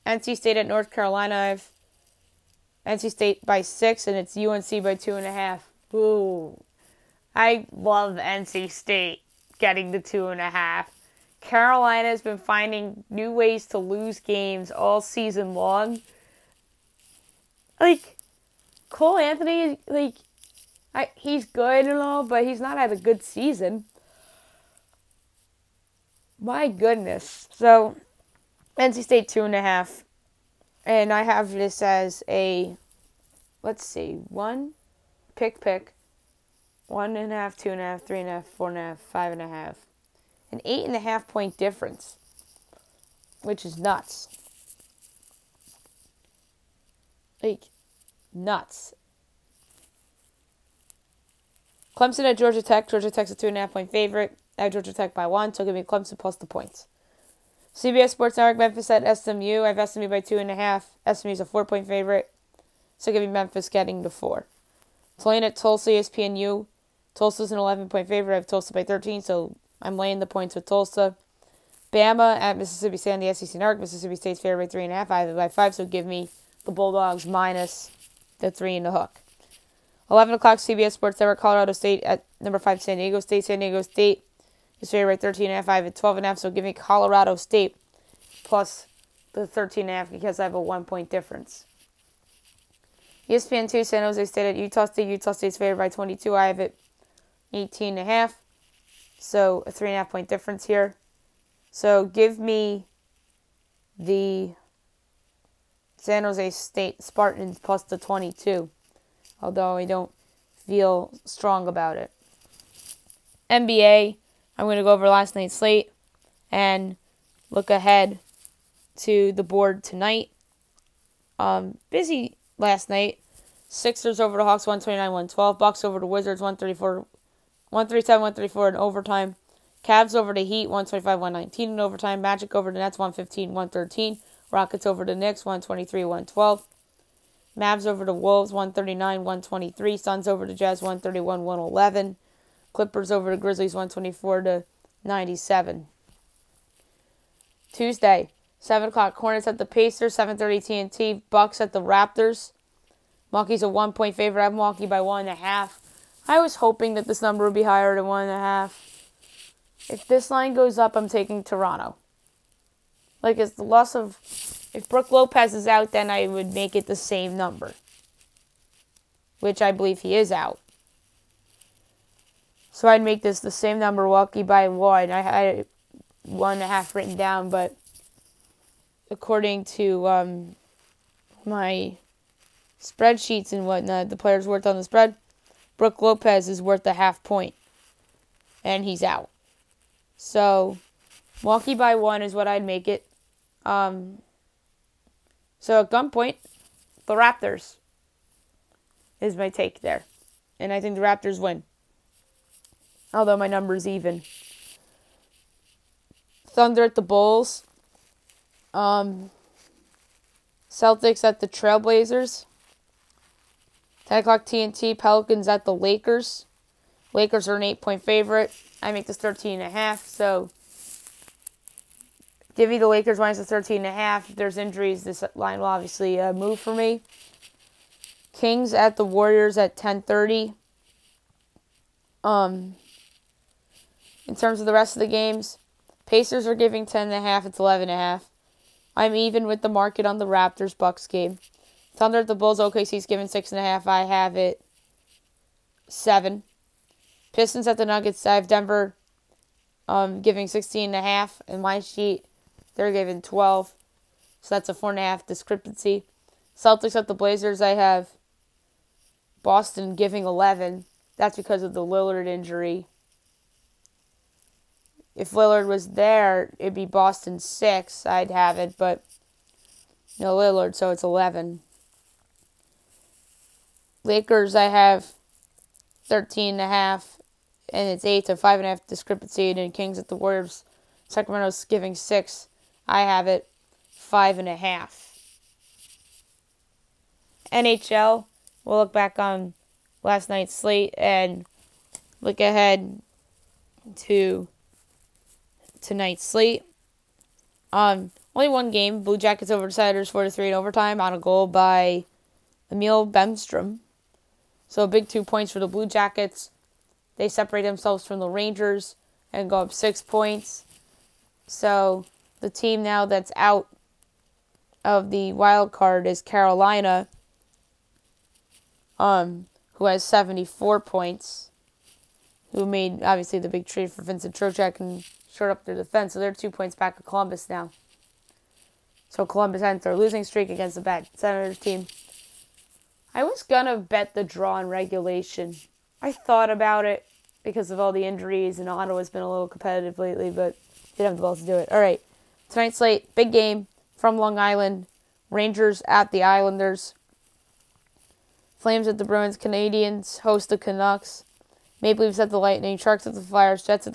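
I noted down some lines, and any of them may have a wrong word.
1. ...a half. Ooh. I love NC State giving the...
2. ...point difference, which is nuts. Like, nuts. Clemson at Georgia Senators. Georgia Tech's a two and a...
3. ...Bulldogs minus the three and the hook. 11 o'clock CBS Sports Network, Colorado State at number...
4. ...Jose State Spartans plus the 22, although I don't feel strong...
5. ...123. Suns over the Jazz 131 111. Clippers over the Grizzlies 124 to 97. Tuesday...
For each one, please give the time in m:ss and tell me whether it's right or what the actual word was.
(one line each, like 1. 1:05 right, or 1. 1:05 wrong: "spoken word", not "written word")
1. 0:05 wrong: "getting", not "giving"
2. 0:41 wrong: "Tech", not "Senators"
3. 1:16 right
4. 1:46 right
5. 2:19 right.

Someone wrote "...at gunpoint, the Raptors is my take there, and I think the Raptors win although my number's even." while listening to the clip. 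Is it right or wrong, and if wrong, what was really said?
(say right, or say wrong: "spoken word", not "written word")
right.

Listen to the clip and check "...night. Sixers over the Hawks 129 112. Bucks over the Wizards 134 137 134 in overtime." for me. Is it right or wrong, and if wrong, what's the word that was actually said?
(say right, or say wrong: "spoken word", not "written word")
right.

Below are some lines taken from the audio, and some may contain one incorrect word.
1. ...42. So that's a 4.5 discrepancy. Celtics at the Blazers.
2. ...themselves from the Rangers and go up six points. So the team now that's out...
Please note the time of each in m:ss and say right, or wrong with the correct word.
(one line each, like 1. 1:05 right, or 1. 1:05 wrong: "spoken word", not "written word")
1. 4:13 wrong: "12", not "42"
2. 5:07 right.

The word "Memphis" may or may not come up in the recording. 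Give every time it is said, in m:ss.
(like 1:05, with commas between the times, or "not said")
0:58, 1:03.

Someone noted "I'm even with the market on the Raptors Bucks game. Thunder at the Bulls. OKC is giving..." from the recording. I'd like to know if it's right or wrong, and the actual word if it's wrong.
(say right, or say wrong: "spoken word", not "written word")
right.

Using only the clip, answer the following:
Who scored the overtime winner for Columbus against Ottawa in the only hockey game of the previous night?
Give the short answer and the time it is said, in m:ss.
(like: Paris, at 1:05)
Emil Bemstrom, at 5:02.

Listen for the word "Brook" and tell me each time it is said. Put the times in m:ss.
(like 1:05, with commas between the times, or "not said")
2:44, 3:05.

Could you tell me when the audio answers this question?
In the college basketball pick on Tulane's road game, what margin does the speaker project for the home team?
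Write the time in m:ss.
1:08.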